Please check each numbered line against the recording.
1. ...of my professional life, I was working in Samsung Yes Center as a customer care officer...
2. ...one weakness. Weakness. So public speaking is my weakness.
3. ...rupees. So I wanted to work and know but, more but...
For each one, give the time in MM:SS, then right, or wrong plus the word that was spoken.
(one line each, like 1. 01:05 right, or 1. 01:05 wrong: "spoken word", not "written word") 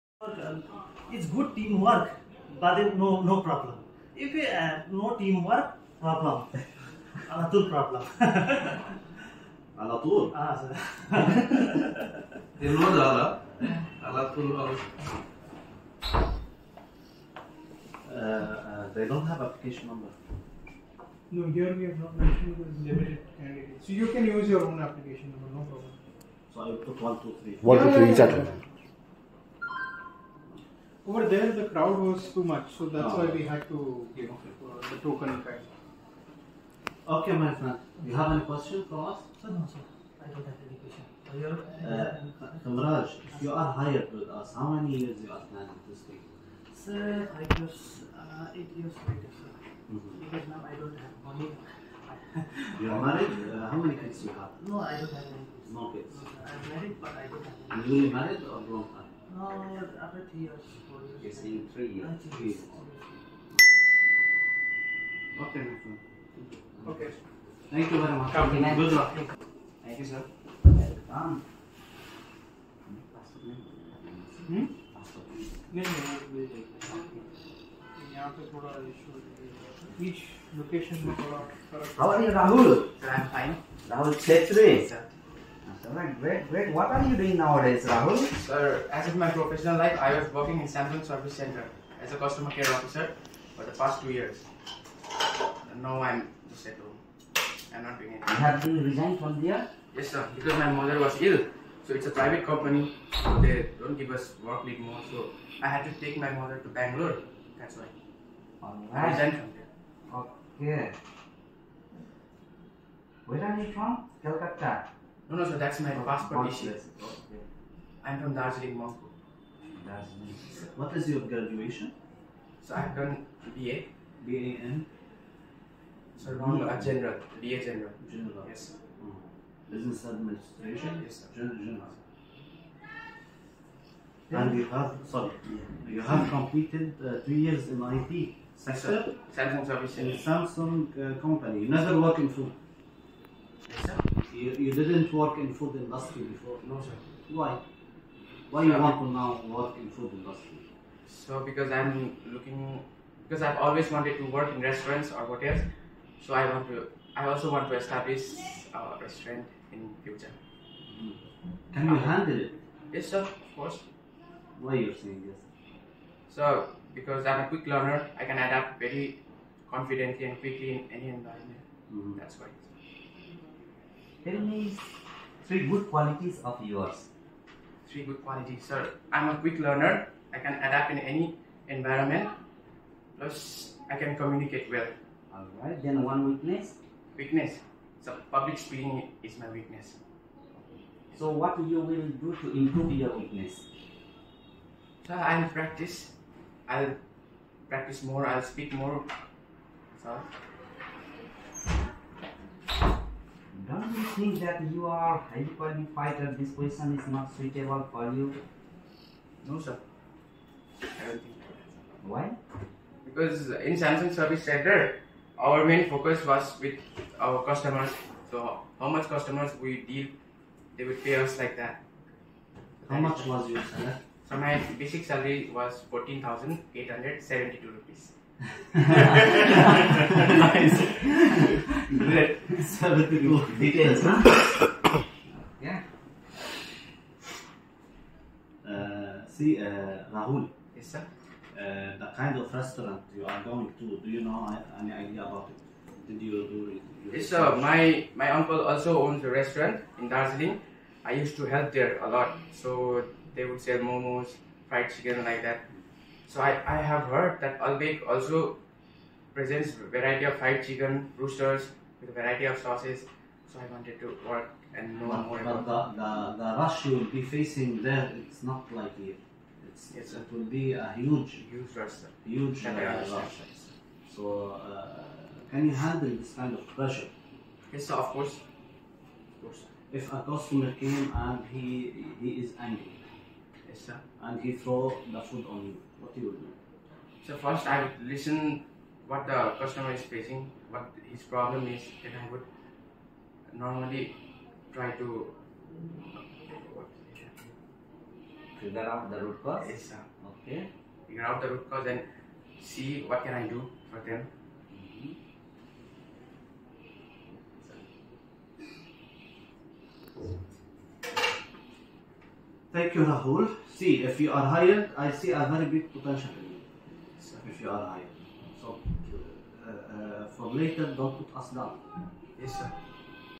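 1. 01:29 wrong: "Service", not "Yes"
2. 03:06 right
3. 04:22 wrong: "sauces", not "rupees".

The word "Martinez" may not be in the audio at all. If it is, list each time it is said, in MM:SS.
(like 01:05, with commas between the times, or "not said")
not said.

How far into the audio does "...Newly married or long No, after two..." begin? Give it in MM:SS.
00:57.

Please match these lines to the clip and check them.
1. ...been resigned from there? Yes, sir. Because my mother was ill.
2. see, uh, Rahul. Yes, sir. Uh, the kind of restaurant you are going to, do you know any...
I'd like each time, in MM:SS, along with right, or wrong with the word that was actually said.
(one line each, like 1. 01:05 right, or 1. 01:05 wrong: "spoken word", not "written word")
1. 01:38 right
2. 03:59 right.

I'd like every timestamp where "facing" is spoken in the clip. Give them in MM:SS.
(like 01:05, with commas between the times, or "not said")
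04:27, 04:50.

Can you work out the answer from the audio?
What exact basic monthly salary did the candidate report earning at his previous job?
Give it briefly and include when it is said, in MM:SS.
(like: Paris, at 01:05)
14,872 rupees, at 03:45.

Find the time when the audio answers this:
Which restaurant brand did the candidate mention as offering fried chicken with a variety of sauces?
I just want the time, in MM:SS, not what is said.
04:17.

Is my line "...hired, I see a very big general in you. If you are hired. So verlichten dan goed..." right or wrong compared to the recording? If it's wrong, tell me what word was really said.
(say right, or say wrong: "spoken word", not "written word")
wrong: "potential", not "general".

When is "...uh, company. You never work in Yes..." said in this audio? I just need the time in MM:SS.
02:20.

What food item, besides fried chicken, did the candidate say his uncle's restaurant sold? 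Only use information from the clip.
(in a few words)
momos.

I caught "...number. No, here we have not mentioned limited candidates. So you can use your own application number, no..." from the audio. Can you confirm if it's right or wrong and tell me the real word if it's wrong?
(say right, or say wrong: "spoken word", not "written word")
right.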